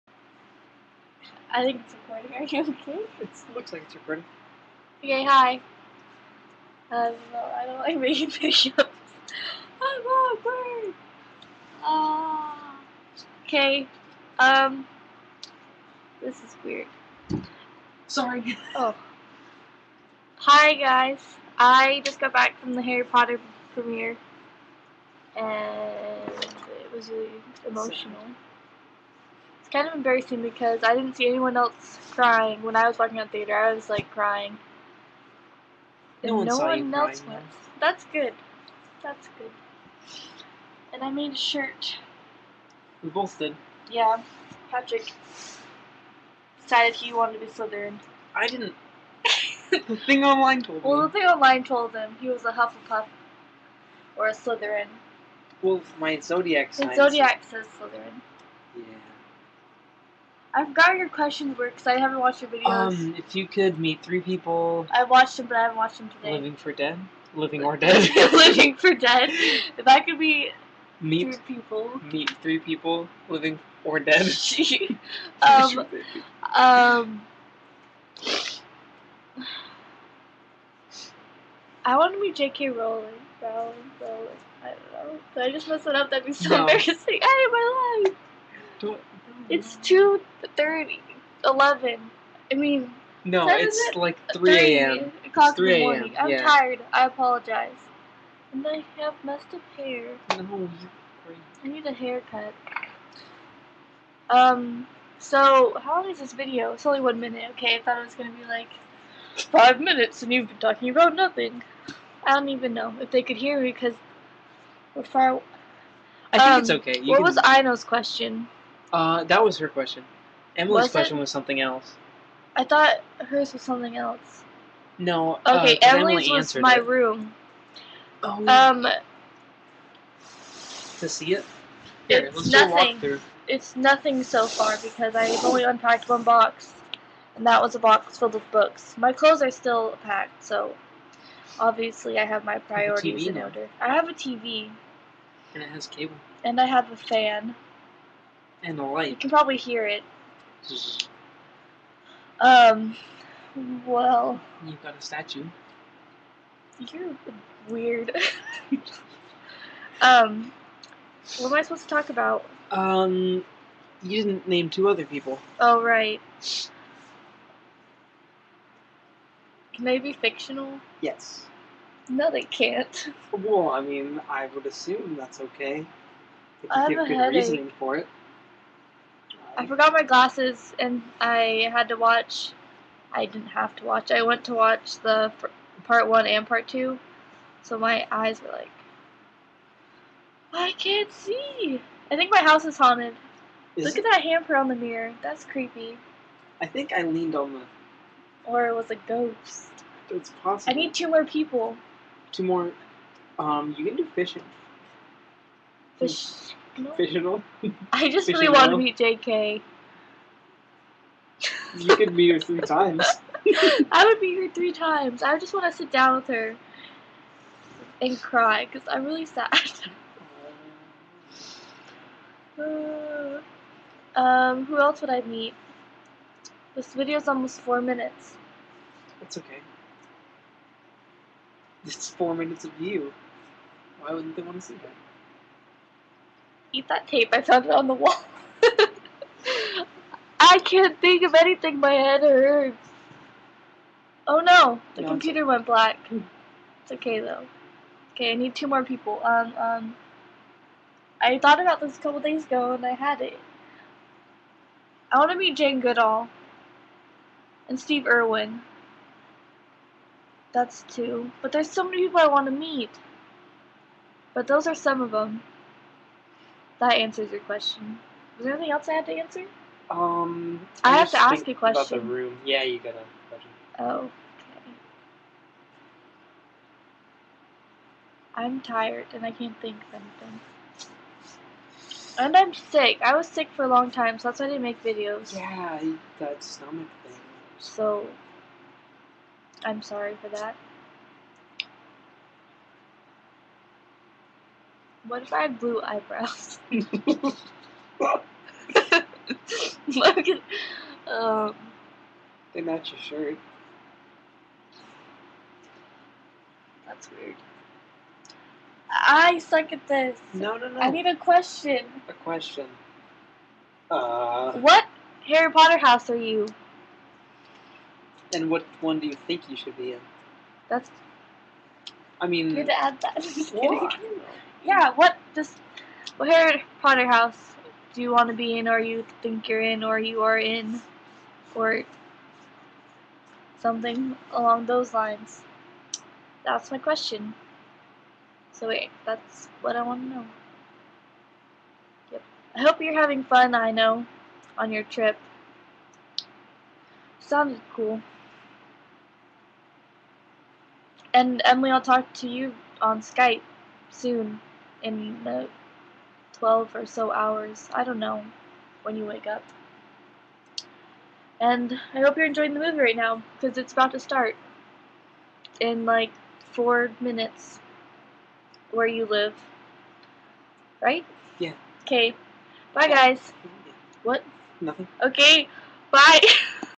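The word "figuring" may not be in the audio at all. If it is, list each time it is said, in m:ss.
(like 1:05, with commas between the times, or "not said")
not said.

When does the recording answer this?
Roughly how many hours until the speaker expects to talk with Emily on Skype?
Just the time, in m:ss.
5:56.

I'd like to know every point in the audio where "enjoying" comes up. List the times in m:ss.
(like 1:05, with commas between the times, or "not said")
6:02.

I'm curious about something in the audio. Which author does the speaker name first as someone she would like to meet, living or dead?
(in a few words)
J.K. Rowling.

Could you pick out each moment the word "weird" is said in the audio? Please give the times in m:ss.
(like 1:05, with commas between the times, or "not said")
0:16, 2:37, 5:07.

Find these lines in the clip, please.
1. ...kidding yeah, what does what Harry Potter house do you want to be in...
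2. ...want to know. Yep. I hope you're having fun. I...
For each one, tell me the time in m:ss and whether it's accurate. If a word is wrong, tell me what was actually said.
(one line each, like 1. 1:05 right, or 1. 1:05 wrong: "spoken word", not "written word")
1. 5:23 right
2. 5:39 right.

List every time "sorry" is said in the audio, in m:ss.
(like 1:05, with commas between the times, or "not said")
0:18, 4:49.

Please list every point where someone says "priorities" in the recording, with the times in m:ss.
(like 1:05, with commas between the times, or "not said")
2:22.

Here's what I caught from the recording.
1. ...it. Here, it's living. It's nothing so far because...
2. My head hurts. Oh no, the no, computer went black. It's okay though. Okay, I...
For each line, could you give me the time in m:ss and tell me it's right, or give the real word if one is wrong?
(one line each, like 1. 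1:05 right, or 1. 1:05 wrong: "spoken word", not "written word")
1. 2:11 wrong: "nothing", not "living"
2. 4:01 right.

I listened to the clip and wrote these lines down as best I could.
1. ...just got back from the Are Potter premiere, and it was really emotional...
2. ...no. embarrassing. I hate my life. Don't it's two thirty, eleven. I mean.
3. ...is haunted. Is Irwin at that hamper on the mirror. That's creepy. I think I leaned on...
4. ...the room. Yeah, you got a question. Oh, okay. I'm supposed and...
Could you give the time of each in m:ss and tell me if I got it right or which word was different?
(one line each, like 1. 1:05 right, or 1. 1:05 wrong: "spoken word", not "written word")
1. 0:22 wrong: "Harry", not "Are"
2. 1:26 right
3. 3:12 wrong: "Look", not "Irwin"
4. 4:31 wrong: "tired", not "supposed".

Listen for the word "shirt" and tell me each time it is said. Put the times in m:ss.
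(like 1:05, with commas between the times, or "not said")
0:41, 5:03.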